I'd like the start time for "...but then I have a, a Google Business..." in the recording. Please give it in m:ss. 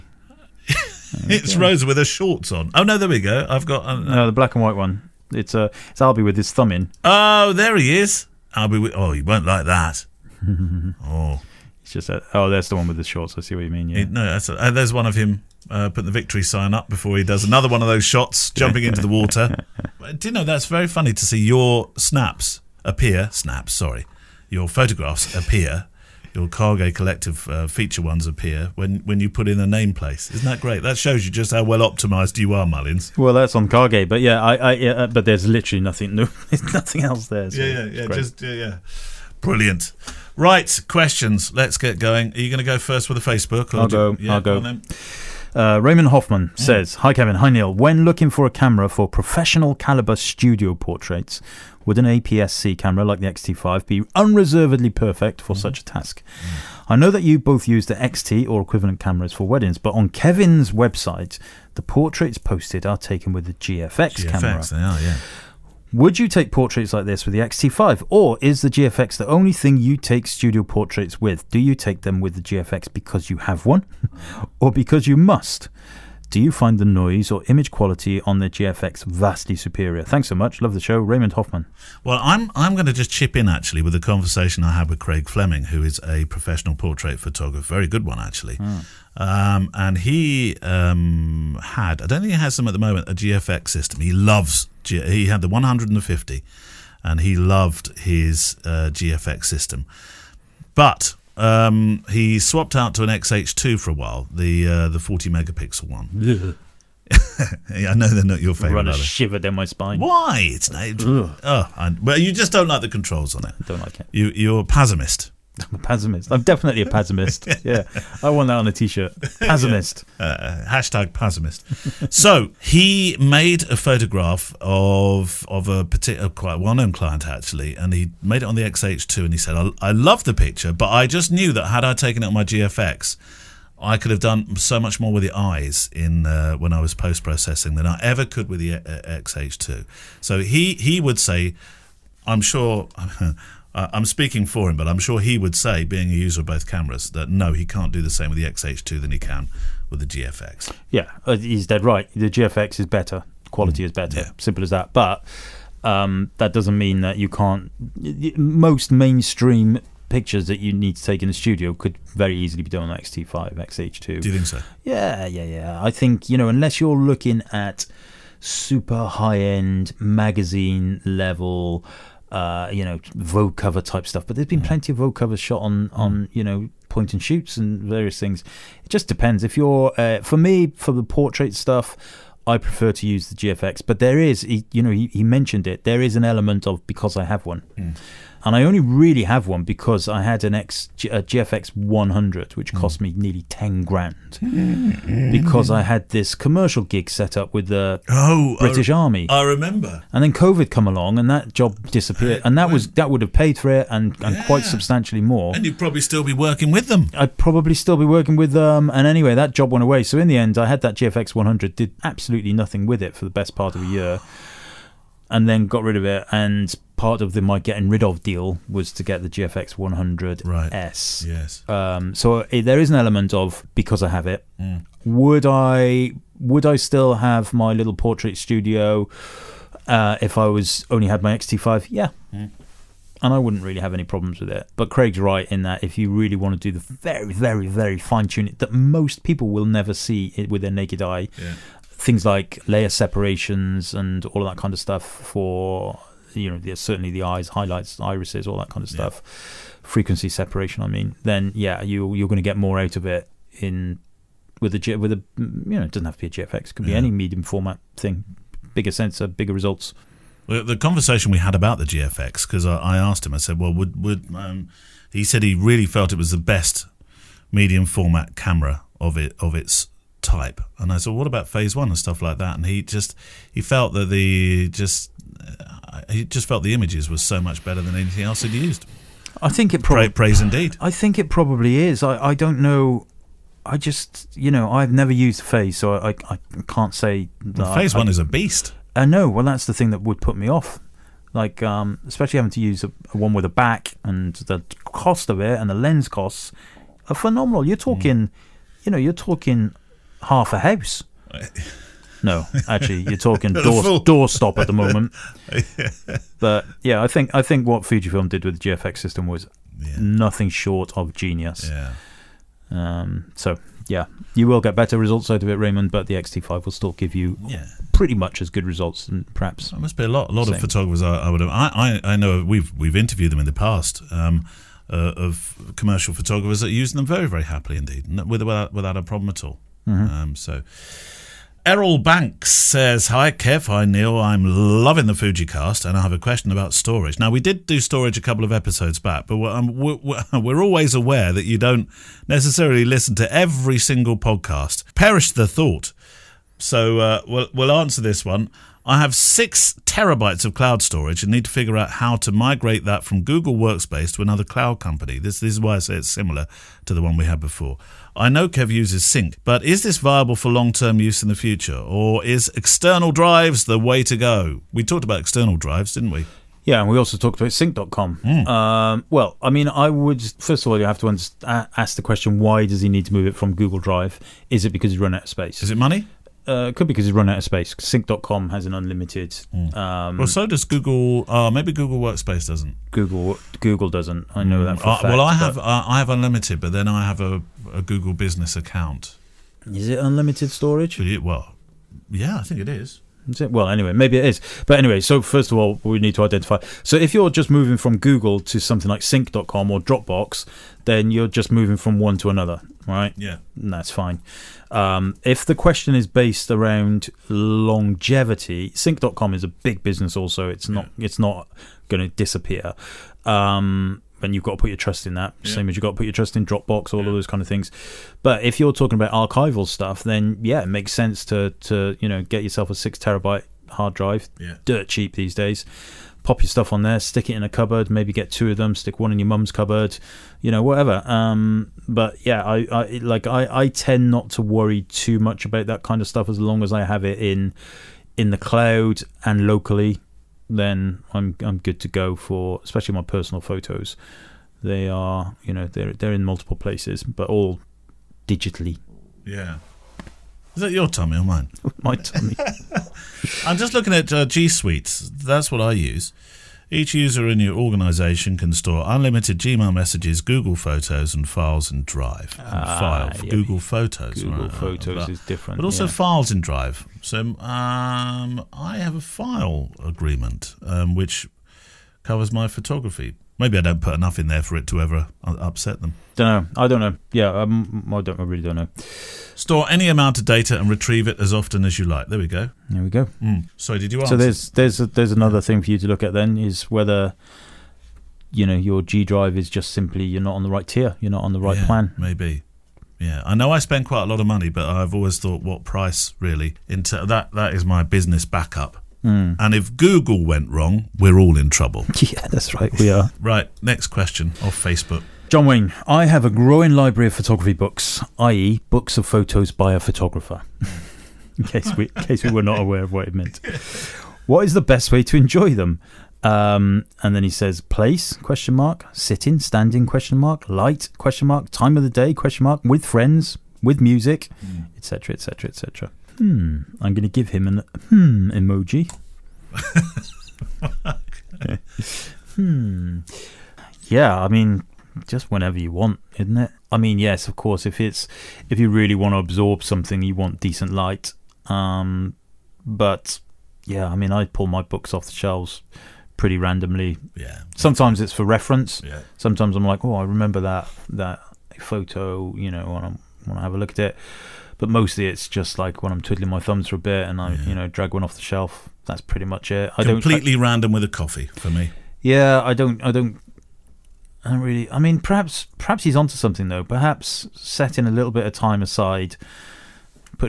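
6:26.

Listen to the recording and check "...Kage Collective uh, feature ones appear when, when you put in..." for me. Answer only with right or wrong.
right.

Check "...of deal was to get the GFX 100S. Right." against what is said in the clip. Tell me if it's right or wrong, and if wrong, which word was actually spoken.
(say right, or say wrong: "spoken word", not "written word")
right.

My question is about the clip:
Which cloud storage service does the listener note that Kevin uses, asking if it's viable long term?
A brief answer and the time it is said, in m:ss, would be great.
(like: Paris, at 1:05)
Sync, at 5:59.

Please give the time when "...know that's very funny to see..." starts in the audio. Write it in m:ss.
0:20.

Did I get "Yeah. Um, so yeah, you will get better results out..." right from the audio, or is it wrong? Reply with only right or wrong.
right.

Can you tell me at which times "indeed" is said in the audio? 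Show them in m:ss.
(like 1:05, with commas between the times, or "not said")
4:40, 5:27.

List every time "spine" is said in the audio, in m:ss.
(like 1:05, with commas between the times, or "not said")
1:49.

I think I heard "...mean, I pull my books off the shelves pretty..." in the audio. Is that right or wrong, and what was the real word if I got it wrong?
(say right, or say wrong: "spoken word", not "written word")
right.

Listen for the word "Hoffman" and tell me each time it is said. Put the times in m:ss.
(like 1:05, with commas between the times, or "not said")
0:46, 1:21.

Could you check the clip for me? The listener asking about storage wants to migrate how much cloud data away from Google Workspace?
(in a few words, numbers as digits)
6 terabytes.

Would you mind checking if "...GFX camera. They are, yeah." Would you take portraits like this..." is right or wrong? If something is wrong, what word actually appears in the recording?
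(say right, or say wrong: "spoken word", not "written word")
right.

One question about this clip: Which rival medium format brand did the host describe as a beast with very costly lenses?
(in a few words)
Phase One.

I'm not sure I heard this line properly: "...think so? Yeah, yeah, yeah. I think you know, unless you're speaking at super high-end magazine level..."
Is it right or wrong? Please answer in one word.
wrong.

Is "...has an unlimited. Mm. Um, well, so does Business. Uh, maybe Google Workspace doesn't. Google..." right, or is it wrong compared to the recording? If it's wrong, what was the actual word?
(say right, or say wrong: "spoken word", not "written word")
wrong: "Google", not "Business".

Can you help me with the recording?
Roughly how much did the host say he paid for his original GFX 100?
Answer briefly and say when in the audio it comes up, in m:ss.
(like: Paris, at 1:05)
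nearly ten grand, at 3:13.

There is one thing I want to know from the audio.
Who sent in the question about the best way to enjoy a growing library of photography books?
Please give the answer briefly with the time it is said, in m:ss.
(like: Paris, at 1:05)
John Wayne, at 8:25.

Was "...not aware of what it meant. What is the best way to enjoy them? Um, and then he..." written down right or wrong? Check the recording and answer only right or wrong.
right.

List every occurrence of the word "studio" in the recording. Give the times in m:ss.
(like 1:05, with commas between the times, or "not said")
0:50, 1:10, 2:41, 3:48.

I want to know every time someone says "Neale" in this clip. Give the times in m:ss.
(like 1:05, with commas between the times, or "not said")
0:47, 5:33.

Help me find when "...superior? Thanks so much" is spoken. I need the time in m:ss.
1:19.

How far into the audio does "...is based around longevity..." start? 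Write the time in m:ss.
6:45.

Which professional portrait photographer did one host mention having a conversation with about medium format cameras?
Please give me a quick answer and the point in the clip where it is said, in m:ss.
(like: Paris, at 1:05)
Craig Fleming, at 1:24.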